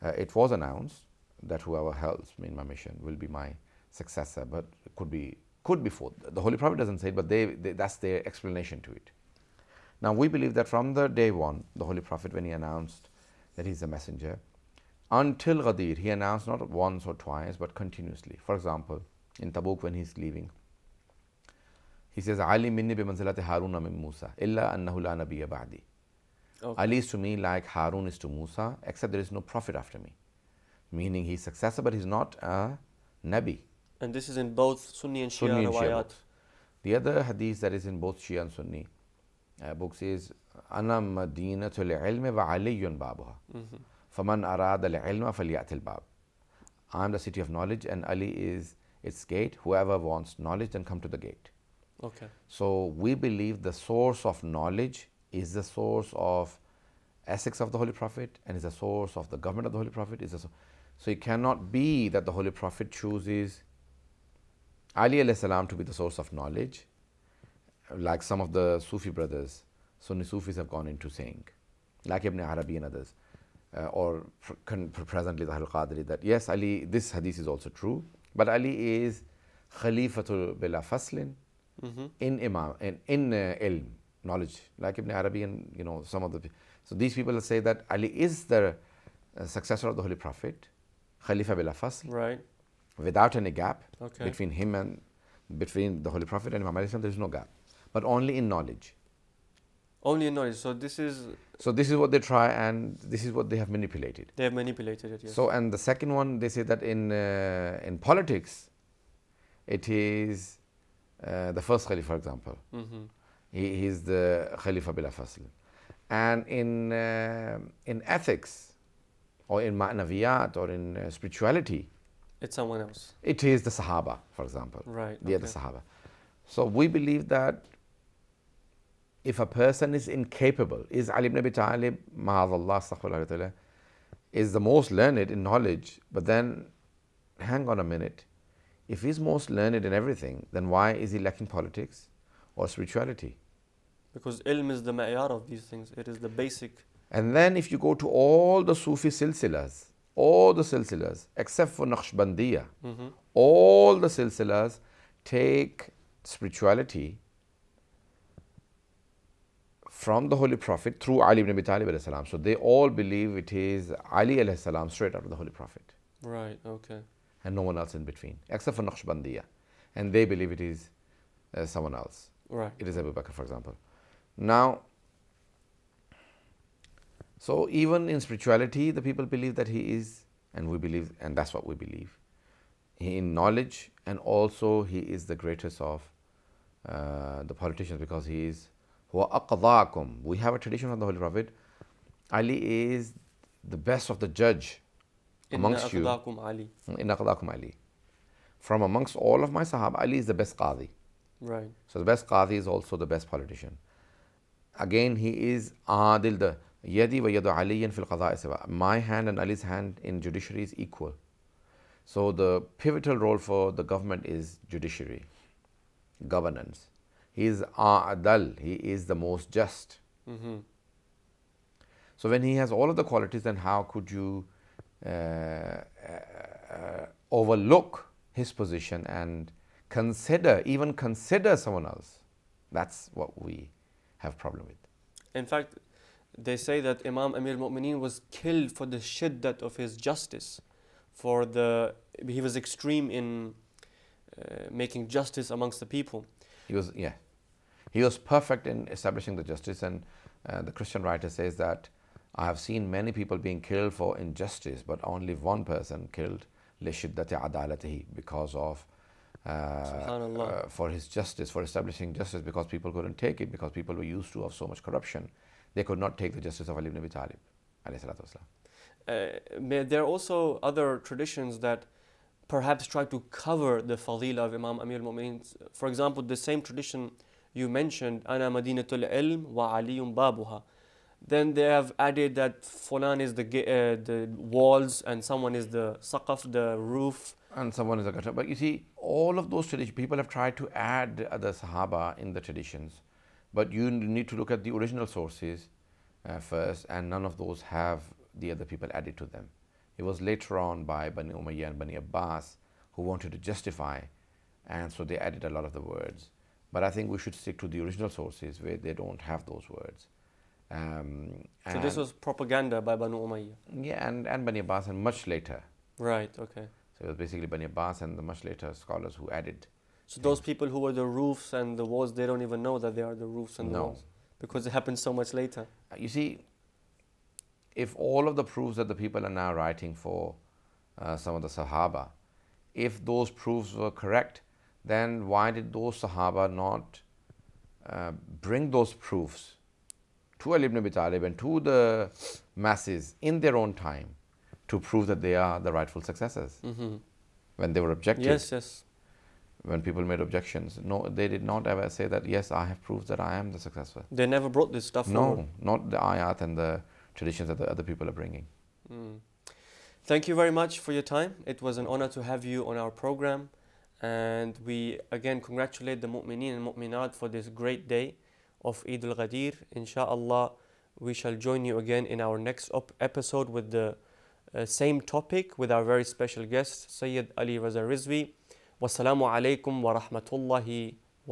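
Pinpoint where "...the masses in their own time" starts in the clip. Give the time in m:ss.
5:41.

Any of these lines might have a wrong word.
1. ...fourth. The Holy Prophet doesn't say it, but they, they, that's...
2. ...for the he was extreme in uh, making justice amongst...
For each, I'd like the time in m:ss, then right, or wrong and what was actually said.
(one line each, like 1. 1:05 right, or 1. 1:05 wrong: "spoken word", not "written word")
1. 0:05 right
2. 4:01 right.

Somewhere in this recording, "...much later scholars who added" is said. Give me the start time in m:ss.
5:18.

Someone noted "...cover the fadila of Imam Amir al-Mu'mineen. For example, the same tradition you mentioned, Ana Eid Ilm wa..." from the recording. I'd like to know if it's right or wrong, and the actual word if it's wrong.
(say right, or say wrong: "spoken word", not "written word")
wrong: "Madinatul", not "Eid".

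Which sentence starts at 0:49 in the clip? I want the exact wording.
Whoever wants knowledge, then come to the gate.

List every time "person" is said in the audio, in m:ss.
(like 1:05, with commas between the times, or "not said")
2:09, 4:15.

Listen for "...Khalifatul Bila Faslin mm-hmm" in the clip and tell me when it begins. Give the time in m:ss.
1:19.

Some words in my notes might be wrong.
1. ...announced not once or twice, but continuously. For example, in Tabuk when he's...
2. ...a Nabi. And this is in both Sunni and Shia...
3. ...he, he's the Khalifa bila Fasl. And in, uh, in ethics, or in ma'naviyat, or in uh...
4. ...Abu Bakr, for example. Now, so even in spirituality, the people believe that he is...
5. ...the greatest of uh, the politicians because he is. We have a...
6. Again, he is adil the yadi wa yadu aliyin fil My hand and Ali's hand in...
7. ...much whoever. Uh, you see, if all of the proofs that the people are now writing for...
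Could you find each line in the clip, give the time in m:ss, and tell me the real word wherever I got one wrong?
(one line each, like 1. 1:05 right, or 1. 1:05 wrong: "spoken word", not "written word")
1. 0:16 right
2. 0:32 right
3. 1:53 right
4. 2:52 right
5. 3:05 right
6. 3:24 right
7. 5:25 wrong: "later", not "whoever".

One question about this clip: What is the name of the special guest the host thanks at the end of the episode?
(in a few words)
Sayyid Ali Raza Rizvi.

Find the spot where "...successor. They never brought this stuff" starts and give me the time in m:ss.
5:53.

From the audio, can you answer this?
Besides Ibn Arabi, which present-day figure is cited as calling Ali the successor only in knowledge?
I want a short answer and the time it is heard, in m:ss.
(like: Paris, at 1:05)
Al-Qadri, at 1:15.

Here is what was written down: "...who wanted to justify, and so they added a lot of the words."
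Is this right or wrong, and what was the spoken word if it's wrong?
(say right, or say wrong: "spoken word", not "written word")
right.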